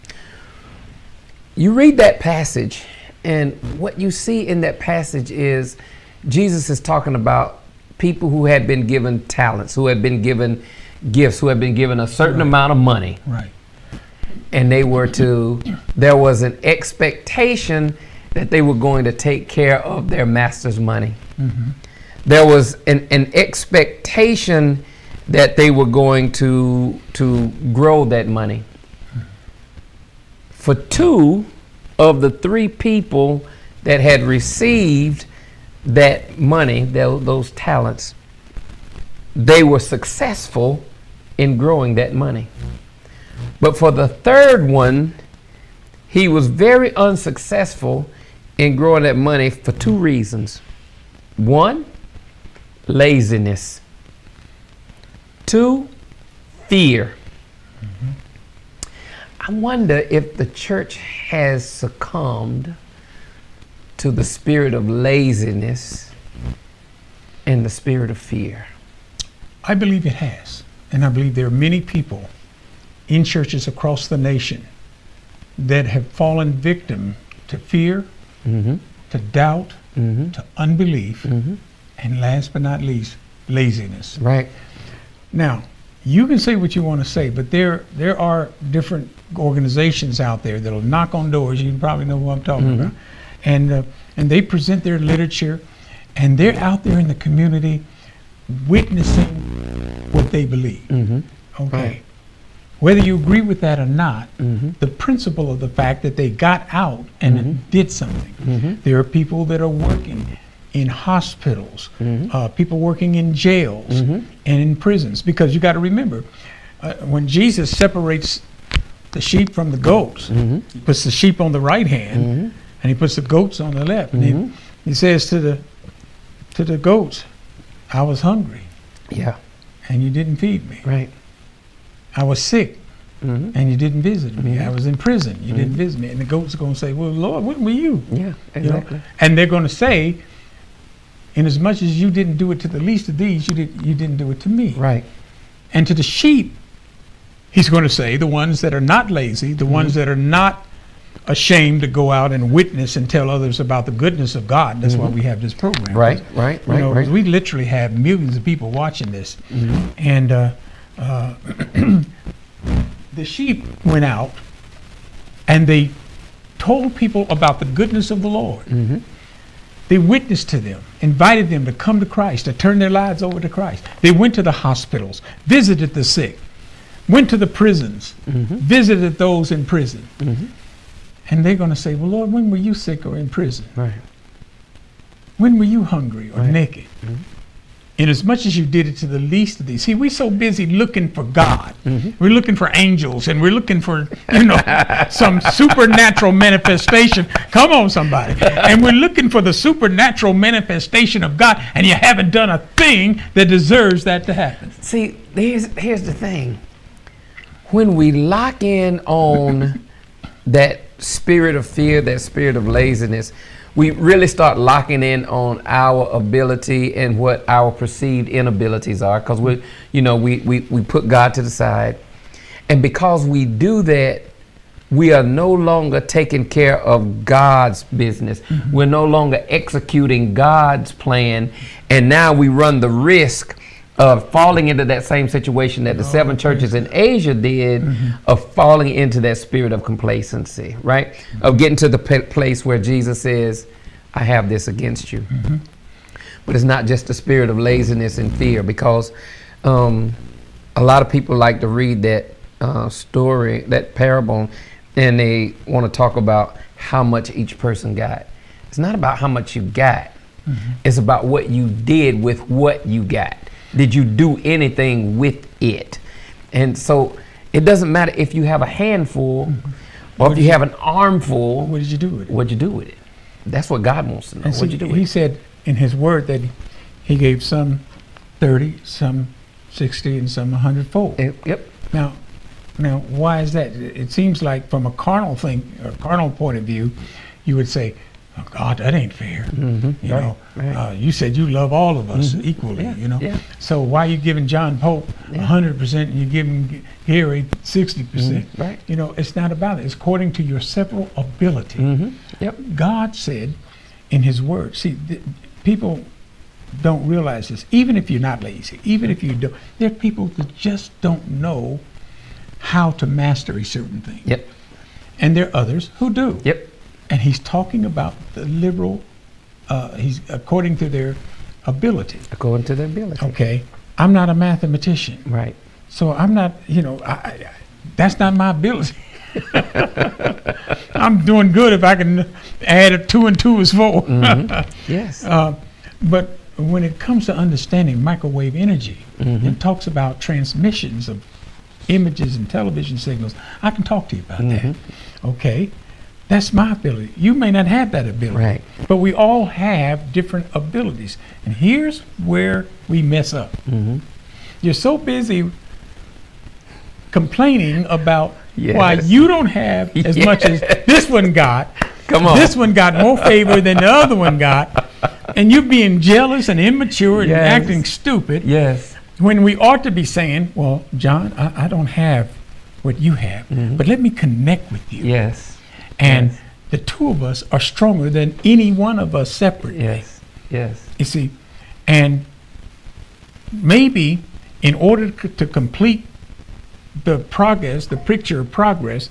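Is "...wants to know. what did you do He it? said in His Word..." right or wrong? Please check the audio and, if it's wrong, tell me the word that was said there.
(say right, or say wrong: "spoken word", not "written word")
right.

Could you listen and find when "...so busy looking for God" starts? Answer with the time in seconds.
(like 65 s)
190 s.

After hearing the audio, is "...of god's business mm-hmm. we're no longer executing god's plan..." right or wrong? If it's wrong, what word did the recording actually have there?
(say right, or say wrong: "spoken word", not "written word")
right.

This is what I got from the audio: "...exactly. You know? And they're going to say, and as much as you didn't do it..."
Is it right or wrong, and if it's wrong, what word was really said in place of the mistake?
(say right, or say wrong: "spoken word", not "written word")
right.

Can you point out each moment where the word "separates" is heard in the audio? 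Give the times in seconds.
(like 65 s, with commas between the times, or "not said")
117 s, 379 s.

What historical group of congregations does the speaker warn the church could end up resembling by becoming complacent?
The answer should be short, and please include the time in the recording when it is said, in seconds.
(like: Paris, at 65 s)
seven churches in Asia, at 236 s.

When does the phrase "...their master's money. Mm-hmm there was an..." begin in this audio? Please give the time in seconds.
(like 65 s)
20 s.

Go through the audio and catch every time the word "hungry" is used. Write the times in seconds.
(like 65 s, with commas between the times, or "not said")
128 s, 185 s.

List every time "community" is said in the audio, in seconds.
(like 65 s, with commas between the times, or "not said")
97 s.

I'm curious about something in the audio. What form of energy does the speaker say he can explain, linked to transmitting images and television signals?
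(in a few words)
microwave energy.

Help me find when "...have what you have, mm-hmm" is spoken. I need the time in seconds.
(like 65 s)
371 s.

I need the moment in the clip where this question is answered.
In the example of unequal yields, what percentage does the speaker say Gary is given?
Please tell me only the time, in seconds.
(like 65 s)
297 s.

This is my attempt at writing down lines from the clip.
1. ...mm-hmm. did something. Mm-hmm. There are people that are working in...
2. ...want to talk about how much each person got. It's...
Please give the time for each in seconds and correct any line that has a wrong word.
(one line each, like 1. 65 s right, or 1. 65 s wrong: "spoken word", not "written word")
1. 107 s right
2. 255 s right.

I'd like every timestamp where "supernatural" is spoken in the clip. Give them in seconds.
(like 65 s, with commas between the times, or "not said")
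195 s, 199 s.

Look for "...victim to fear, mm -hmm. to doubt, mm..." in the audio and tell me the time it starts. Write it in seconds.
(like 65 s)
76 s.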